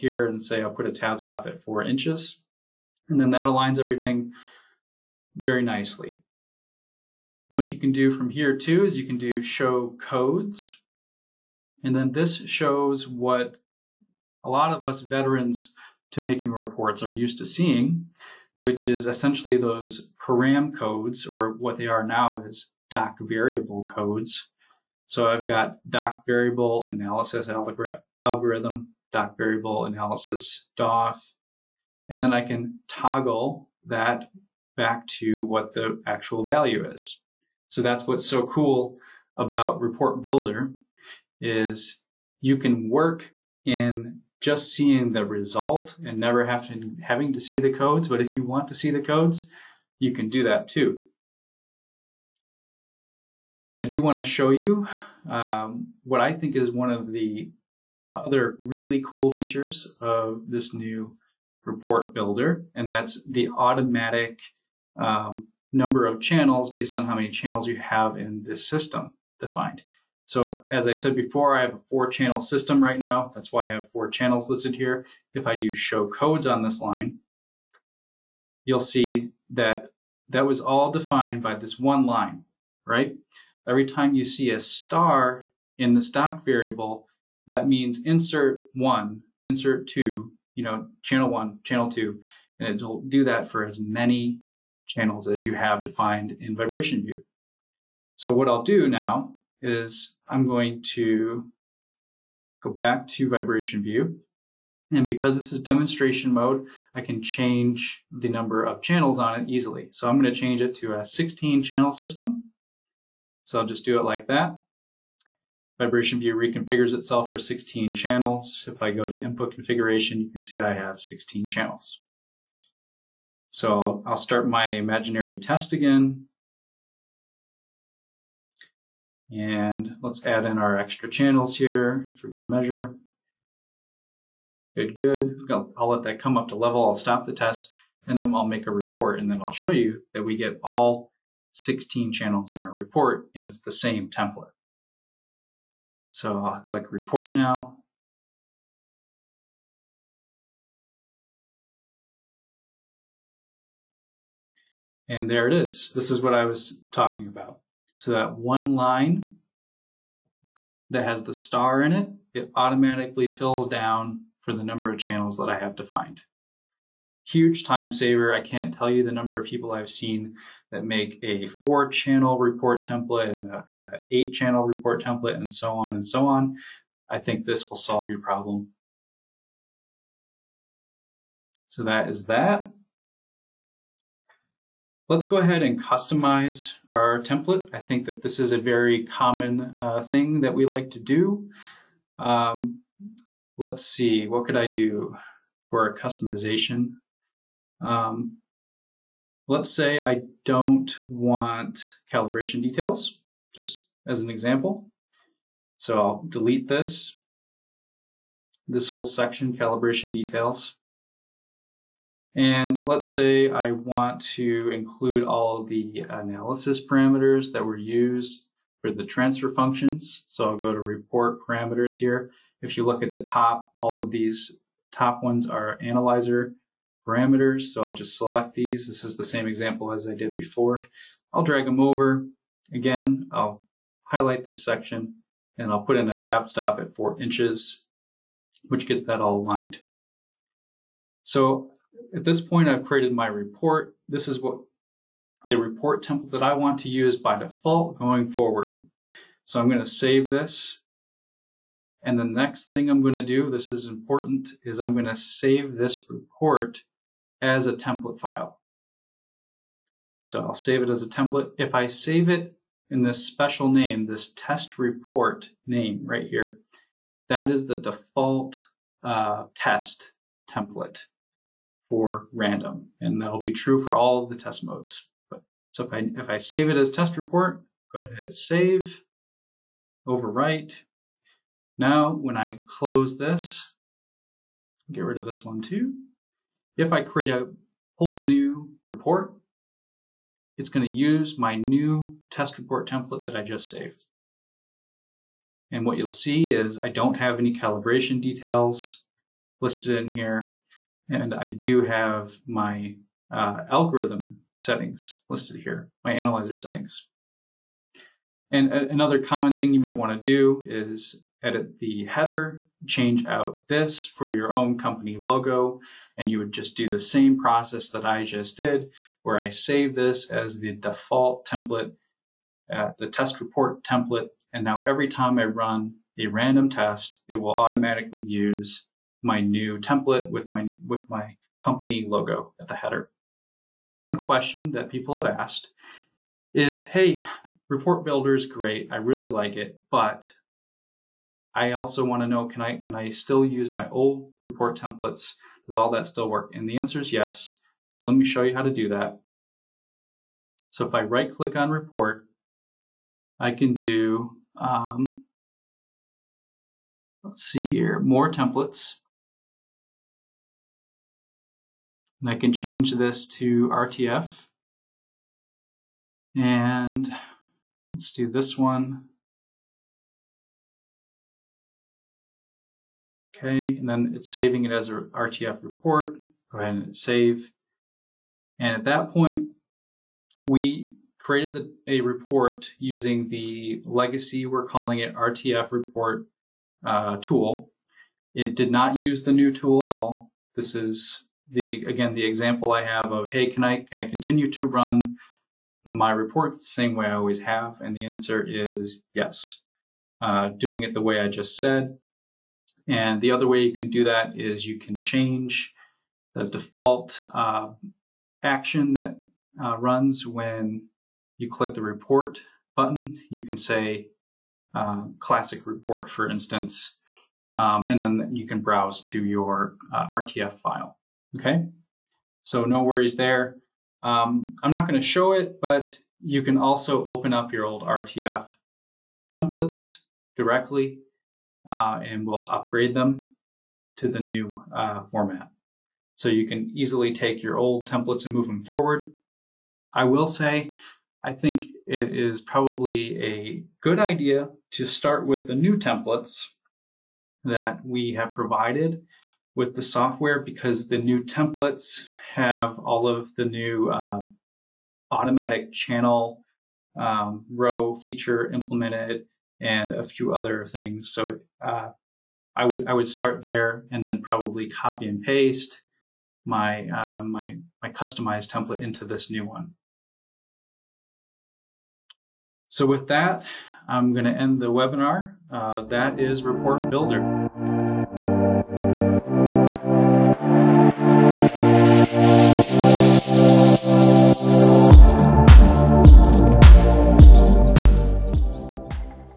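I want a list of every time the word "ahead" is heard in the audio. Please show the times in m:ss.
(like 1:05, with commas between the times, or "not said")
3:05, 4:37, 6:16.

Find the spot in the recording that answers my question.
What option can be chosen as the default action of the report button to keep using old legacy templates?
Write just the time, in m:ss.
6:55.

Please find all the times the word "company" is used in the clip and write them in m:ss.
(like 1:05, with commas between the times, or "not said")
5:14, 5:31.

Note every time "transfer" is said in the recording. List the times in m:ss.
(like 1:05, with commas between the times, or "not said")
3:39.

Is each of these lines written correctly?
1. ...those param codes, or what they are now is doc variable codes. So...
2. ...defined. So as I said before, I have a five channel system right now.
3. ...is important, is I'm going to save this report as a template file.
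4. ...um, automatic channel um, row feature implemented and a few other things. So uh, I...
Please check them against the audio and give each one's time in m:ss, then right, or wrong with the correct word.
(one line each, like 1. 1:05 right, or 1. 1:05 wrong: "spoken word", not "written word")
1. 0:19 right
2. 1:09 wrong: "four", not "five"
3. 4:13 right
4. 7:33 right.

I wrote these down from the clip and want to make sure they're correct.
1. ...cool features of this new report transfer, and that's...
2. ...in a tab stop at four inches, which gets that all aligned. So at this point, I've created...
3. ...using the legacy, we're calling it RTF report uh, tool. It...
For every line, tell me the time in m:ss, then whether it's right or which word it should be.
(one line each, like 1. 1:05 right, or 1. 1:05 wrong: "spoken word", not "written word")
1. 0:59 wrong: "builder", not "transfer"
2. 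3:55 right
3. 6:22 right.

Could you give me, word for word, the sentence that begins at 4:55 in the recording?
And what you'll see is I don't have any calibration details listed in here.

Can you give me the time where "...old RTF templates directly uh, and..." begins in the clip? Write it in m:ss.
7:07.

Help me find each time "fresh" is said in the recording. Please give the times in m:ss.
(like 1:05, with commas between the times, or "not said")
not said.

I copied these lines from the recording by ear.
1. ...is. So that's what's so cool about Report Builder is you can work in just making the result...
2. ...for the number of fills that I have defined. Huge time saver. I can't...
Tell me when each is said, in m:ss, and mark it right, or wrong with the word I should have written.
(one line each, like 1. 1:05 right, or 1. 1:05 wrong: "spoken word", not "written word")
1. 0:36 wrong: "seeing", not "making"
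2. 2:44 wrong: "channels", not "fills".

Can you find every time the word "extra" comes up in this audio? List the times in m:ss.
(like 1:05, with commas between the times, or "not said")
2:10.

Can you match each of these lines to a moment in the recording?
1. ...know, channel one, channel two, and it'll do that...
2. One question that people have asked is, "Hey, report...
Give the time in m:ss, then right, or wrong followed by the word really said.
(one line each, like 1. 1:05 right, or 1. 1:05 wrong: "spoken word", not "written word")
1. 1:30 right
2. 5:34 right.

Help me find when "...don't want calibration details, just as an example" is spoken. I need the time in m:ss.
3:20.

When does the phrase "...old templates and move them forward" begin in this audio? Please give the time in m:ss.
7:17.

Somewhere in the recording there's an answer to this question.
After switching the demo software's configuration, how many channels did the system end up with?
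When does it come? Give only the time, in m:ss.
1:51.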